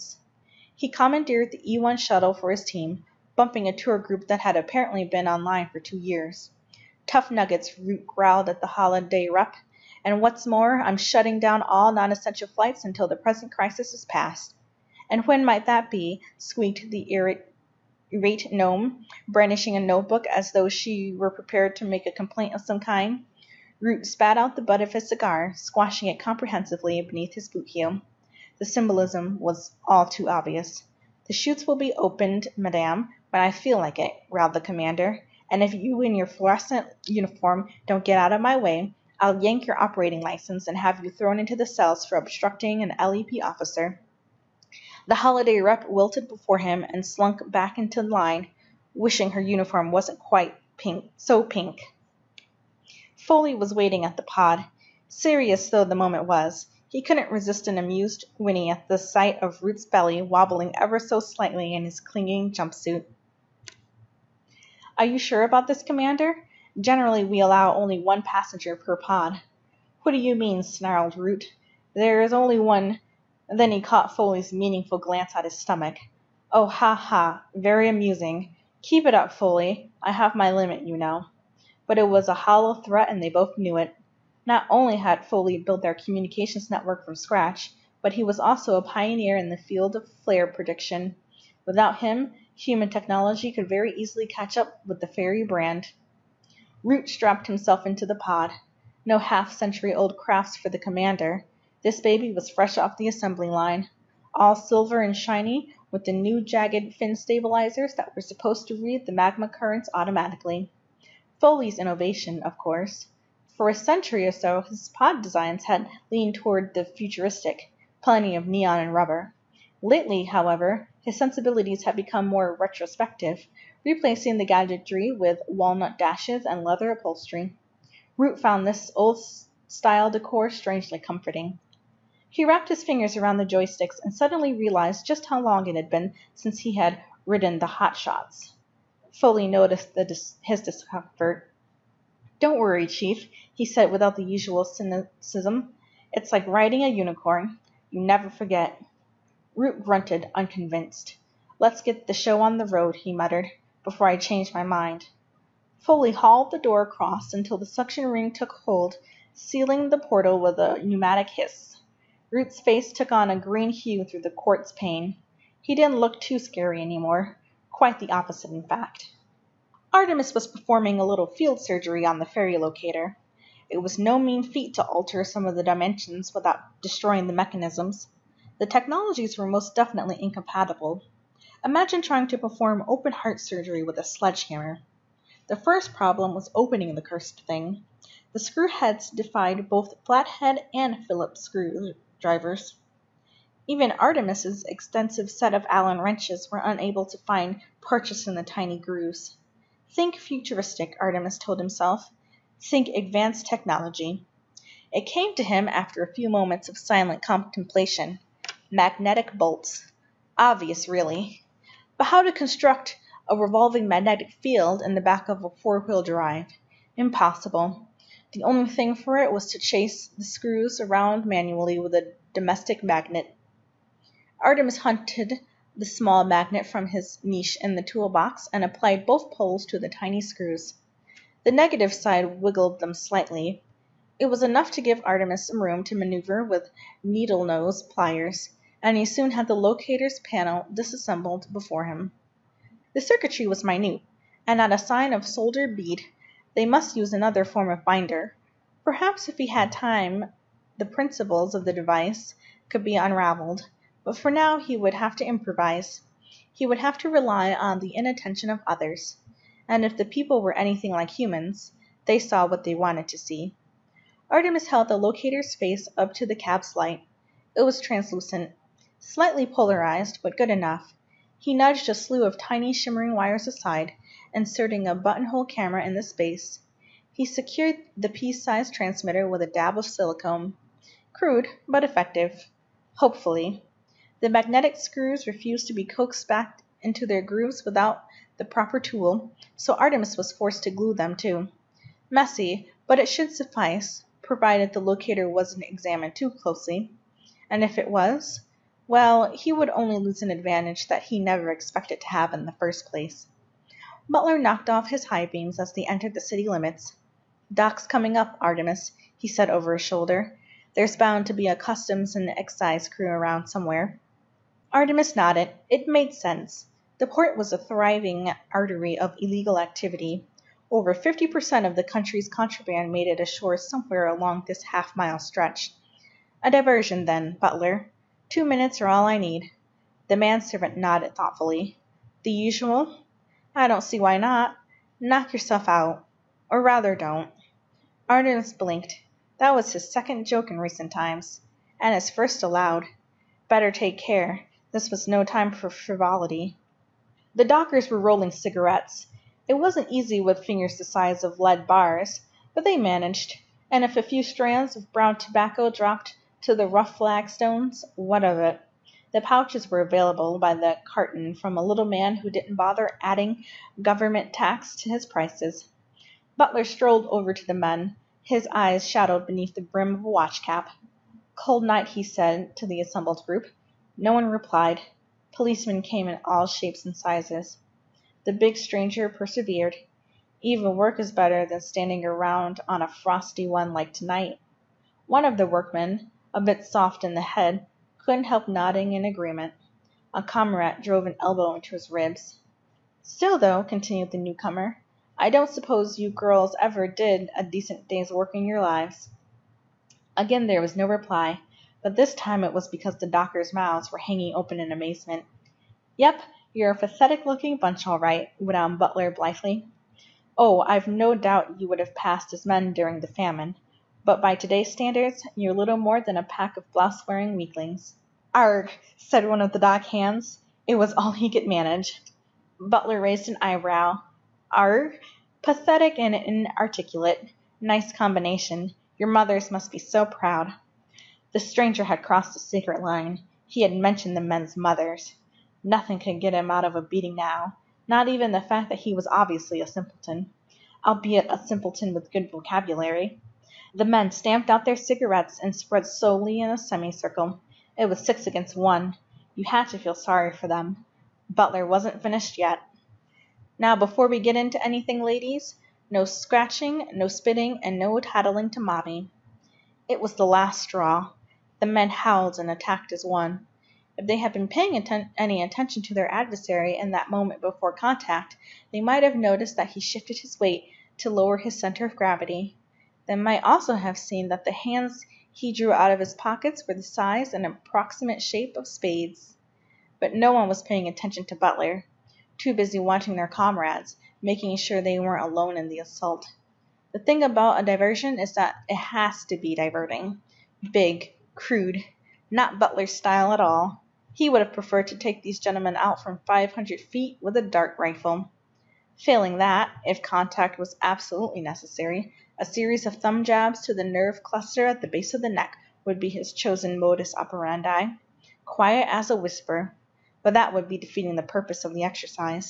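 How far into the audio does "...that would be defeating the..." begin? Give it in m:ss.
8:30.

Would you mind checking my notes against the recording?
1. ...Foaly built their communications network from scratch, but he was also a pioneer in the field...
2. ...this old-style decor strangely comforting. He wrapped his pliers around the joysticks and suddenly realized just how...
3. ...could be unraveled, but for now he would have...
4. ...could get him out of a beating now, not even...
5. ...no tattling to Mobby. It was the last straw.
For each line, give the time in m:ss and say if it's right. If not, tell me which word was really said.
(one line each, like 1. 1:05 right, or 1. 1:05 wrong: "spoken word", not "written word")
1. 1:25 right
2. 2:08 wrong: "fingers", not "pliers"
3. 4:12 right
4. 7:15 right
5. 7:37 right.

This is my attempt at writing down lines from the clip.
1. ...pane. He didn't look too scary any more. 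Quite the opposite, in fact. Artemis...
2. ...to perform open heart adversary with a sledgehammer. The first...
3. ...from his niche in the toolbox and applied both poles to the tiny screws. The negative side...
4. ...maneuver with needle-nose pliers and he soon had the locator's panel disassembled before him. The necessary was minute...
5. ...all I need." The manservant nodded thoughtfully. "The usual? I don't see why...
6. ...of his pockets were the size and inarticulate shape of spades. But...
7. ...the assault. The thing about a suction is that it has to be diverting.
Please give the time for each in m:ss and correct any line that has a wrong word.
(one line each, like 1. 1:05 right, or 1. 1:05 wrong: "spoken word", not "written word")
1. 2:44 right
2. 3:02 wrong: "surgery", not "adversary"
3. 3:46 right
4. 3:55 wrong: "circuitry", not "necessary"
5. 5:28 right
6. 7:55 wrong: "approximate", not "inarticulate"
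7. 8:05 wrong: "diversion", not "suction".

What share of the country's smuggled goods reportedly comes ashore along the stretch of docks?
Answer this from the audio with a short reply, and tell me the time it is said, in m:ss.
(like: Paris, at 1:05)
over 50%, at 5:20.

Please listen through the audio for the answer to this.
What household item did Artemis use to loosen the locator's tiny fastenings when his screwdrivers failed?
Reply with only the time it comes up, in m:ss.
3:42.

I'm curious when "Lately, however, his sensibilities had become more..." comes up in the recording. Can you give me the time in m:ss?
1:59.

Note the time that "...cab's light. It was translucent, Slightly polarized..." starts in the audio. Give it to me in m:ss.
4:26.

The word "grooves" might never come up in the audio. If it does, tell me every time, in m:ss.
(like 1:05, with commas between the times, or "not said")
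3:18, 4:47.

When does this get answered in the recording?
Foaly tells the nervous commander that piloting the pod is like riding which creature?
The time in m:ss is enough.
2:26.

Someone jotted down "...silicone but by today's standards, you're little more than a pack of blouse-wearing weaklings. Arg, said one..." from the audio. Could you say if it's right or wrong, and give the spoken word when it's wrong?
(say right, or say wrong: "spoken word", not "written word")
wrong: "famine", not "silicone".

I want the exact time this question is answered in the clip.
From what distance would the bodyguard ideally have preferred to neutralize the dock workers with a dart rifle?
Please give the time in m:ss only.
8:16.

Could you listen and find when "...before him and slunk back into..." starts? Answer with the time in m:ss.
0:46.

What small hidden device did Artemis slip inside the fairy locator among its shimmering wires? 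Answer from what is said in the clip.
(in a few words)
buttonhole camera.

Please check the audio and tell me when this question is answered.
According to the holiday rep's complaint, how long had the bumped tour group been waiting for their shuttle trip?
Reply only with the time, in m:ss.
0:05.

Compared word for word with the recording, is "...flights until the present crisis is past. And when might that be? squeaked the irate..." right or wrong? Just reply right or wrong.
right.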